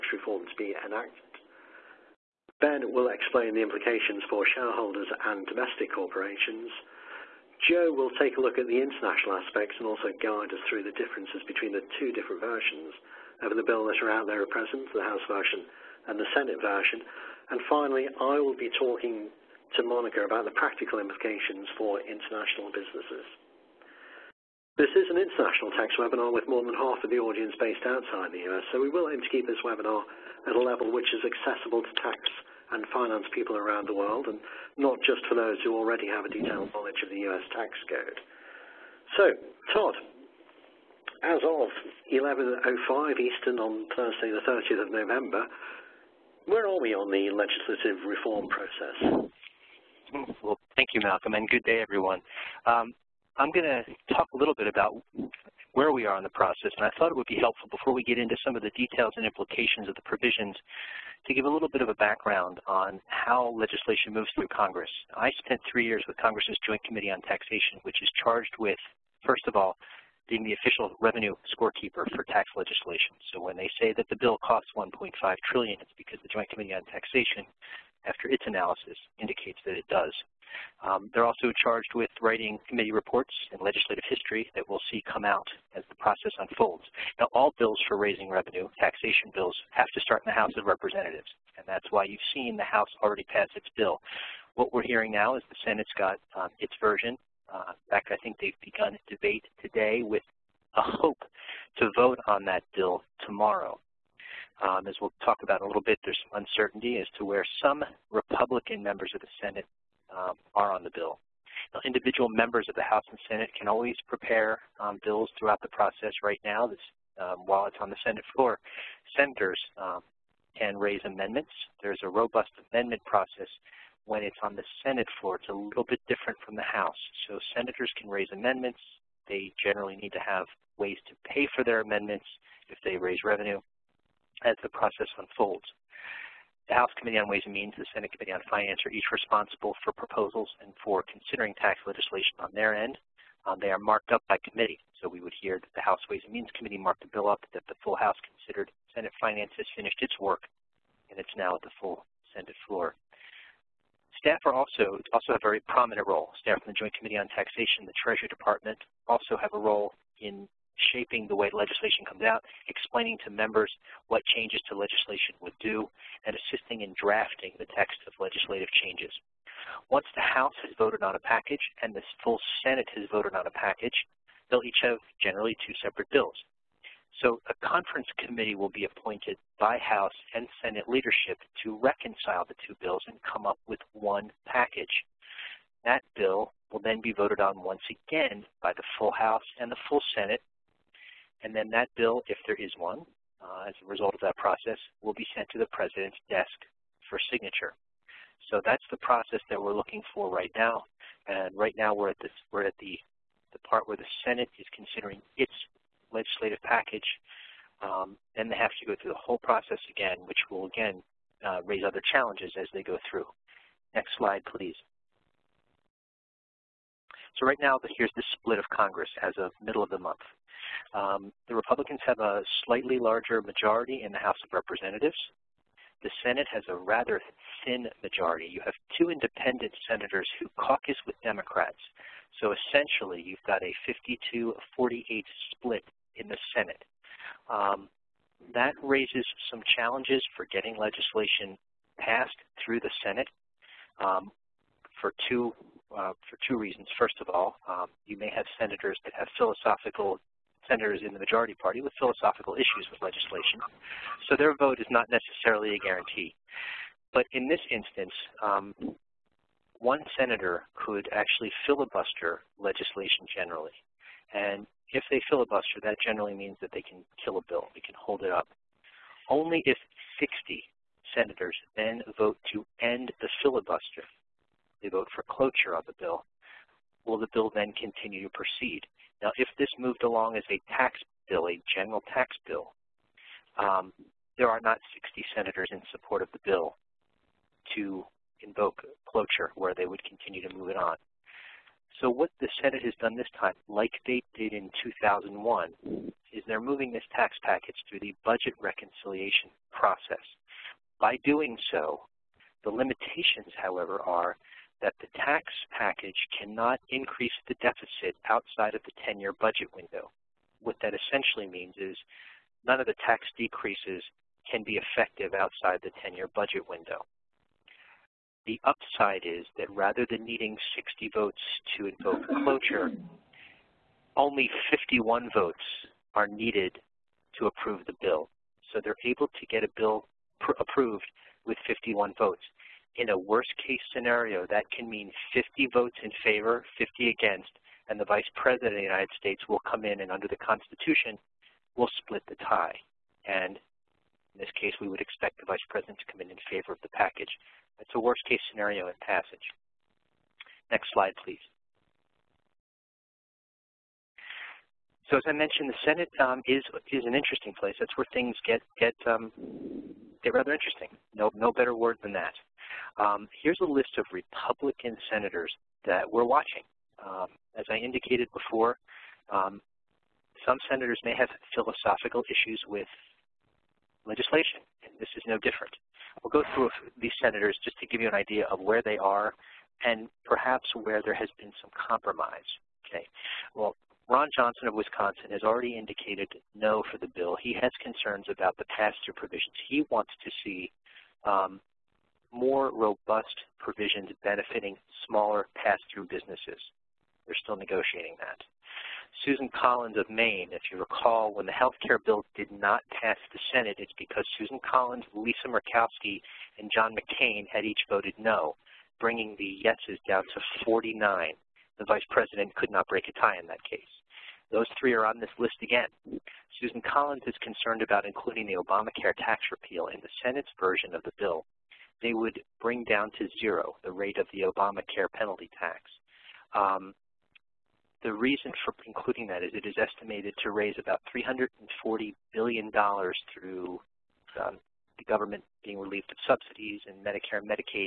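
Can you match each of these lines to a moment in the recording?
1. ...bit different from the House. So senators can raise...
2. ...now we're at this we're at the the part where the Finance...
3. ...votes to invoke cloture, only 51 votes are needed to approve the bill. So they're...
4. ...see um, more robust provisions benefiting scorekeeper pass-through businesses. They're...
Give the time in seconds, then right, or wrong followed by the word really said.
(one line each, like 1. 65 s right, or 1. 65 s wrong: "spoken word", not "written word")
1. 125 s right
2. 201 s wrong: "Senate", not "Finance"
3. 321 s right
4. 390 s wrong: "smaller", not "scorekeeper".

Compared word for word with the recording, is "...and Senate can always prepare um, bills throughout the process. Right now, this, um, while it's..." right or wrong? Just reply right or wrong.
right.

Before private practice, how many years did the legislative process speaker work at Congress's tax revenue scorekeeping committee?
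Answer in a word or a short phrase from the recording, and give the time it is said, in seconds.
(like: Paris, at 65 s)
3, at 65 s.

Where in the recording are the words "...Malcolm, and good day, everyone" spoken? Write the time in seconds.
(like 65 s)
51 s.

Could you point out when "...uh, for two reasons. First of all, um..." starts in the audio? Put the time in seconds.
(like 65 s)
245 s.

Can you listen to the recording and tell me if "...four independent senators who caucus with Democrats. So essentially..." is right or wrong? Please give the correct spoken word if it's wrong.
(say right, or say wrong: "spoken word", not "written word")
wrong: "two", not "four".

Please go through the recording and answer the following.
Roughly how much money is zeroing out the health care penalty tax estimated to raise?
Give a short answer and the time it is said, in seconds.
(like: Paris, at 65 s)
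$340 billion, at 431 s.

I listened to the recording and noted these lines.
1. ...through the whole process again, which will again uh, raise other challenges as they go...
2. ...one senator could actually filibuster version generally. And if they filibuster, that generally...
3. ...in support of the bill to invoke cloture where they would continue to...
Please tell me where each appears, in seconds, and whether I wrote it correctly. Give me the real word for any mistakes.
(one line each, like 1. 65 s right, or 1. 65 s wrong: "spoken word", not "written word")
1. 209 s right
2. 259 s wrong: "legislation", not "version"
3. 285 s right.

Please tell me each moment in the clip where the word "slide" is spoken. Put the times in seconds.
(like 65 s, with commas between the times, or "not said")
214 s, 350 s.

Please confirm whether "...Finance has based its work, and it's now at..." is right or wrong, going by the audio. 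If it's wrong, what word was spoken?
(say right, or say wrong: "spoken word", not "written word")
wrong: "finished", not "based".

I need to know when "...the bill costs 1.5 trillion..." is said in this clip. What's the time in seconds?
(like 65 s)
74 s.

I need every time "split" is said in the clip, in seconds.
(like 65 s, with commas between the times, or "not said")
218 s, 235 s, 342 s.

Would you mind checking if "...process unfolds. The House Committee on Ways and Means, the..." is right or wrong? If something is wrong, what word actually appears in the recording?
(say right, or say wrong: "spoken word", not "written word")
right.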